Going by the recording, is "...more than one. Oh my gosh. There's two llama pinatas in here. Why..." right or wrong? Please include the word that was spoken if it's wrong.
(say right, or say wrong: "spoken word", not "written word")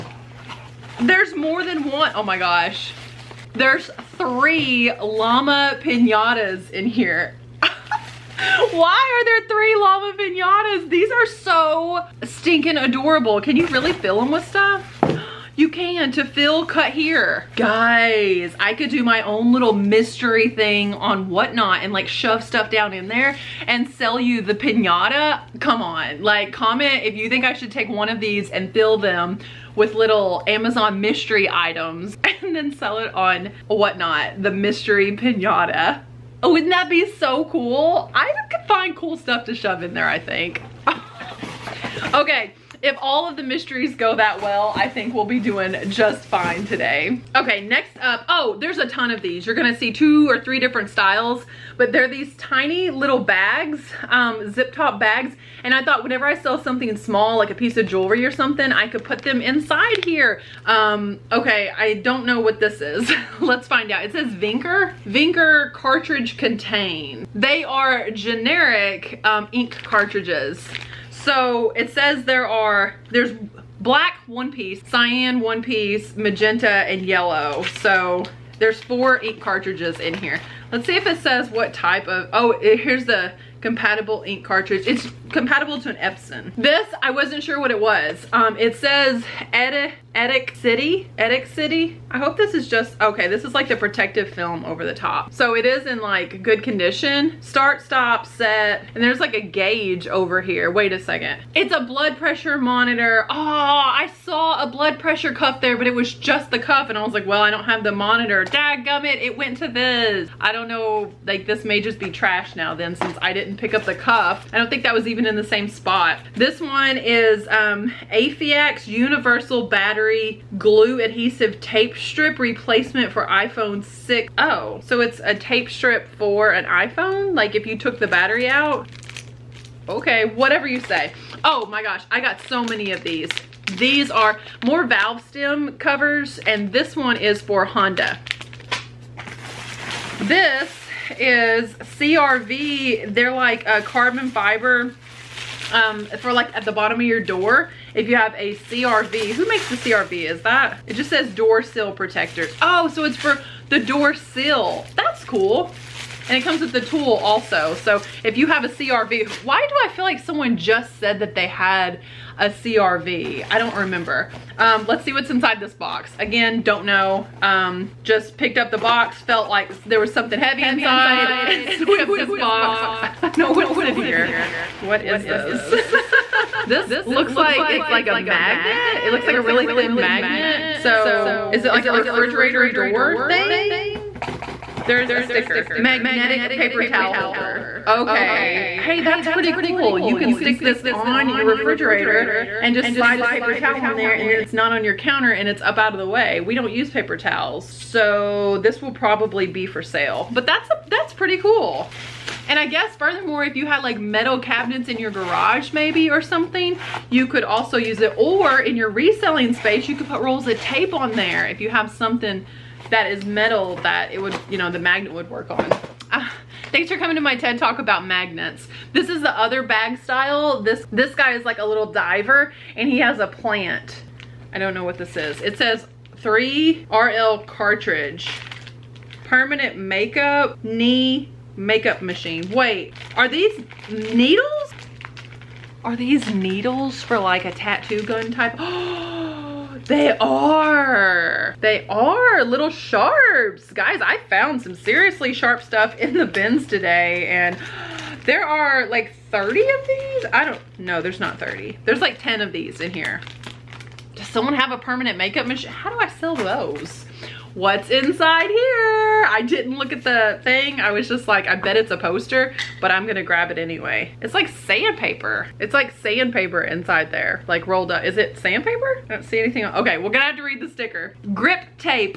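wrong: "three", not "two".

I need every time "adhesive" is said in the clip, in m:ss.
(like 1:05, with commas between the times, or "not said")
2:01.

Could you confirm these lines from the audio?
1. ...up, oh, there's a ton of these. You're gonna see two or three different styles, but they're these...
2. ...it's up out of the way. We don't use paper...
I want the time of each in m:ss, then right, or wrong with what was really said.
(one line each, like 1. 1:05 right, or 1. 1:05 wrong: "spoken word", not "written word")
1. 0:47 right
2. 3:15 right.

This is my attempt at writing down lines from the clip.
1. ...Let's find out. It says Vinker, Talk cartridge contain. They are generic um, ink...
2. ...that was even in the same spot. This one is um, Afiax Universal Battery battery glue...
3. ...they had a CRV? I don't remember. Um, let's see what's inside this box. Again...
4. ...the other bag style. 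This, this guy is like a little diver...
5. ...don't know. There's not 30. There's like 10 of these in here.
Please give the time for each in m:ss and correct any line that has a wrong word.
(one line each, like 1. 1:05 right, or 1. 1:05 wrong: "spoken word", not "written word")
1. 1:03 wrong: "Vinker", not "Talk"
2. 1:54 right
3. 2:41 right
4. 3:39 right
5. 4:10 right.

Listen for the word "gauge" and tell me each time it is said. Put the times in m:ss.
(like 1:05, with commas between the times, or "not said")
1:39.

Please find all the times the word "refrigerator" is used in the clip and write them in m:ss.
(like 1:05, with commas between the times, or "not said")
3:01, 3:11.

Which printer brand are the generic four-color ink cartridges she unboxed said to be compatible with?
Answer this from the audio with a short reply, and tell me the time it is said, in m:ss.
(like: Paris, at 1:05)
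Epson, at 1:25.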